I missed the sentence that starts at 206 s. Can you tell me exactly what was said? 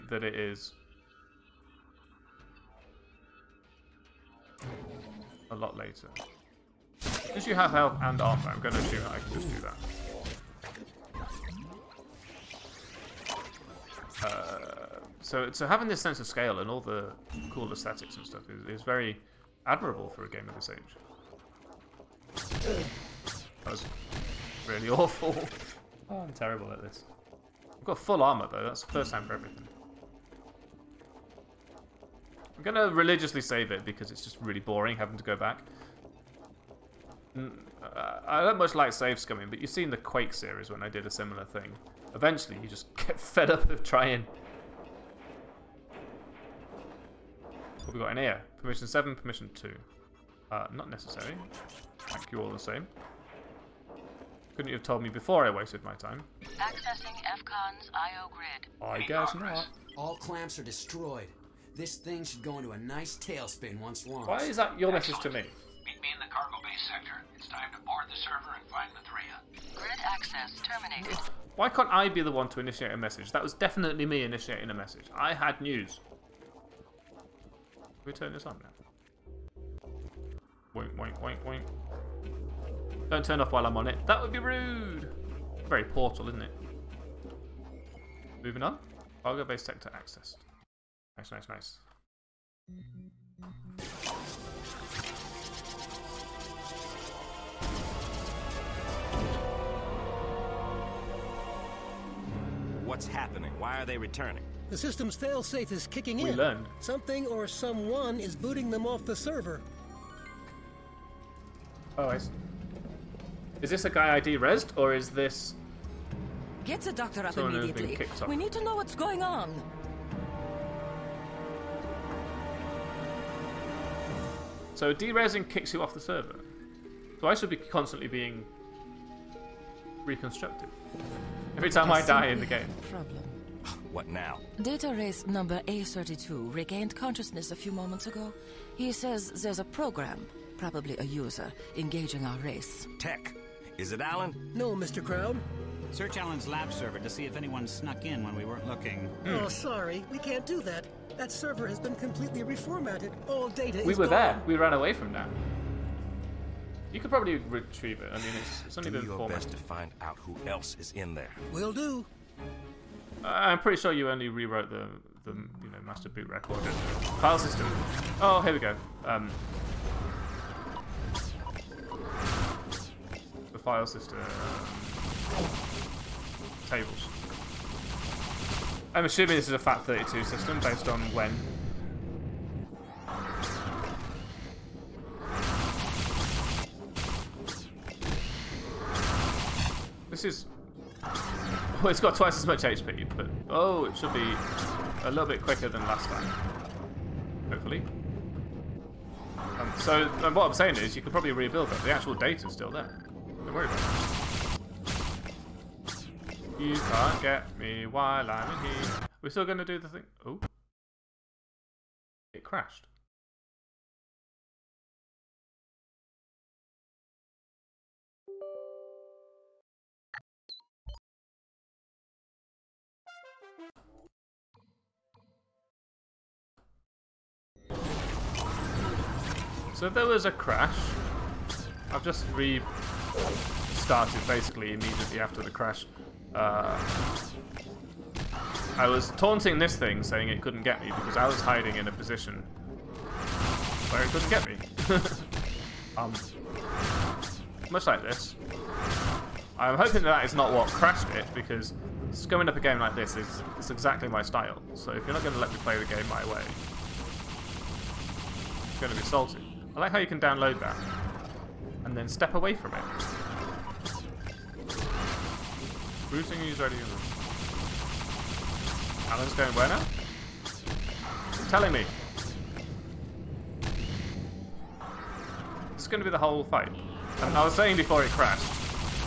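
You can't get me while I'm in here.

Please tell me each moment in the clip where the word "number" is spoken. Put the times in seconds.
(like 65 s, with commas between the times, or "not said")
135 s.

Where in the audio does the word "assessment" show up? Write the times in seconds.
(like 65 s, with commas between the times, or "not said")
not said.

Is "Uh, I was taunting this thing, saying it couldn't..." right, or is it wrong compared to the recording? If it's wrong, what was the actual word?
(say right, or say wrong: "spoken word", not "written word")
right.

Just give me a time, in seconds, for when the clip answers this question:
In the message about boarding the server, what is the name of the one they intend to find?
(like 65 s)
68 s.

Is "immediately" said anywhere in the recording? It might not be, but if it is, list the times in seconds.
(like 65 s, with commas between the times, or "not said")
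117 s, 234 s.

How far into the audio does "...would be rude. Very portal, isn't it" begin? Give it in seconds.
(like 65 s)
84 s.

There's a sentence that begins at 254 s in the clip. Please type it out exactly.
So if you're not going to let me play the game my way, it's going to be salty.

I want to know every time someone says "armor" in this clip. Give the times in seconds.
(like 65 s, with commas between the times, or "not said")
8 s, 28 s.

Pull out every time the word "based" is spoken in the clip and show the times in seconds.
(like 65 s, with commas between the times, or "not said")
89 s, 180 s.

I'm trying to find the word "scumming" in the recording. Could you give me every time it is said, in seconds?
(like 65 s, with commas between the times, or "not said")
39 s, 252 s.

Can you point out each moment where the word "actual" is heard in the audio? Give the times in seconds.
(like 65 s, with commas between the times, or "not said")
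201 s.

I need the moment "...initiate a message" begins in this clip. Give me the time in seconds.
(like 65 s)
72 s.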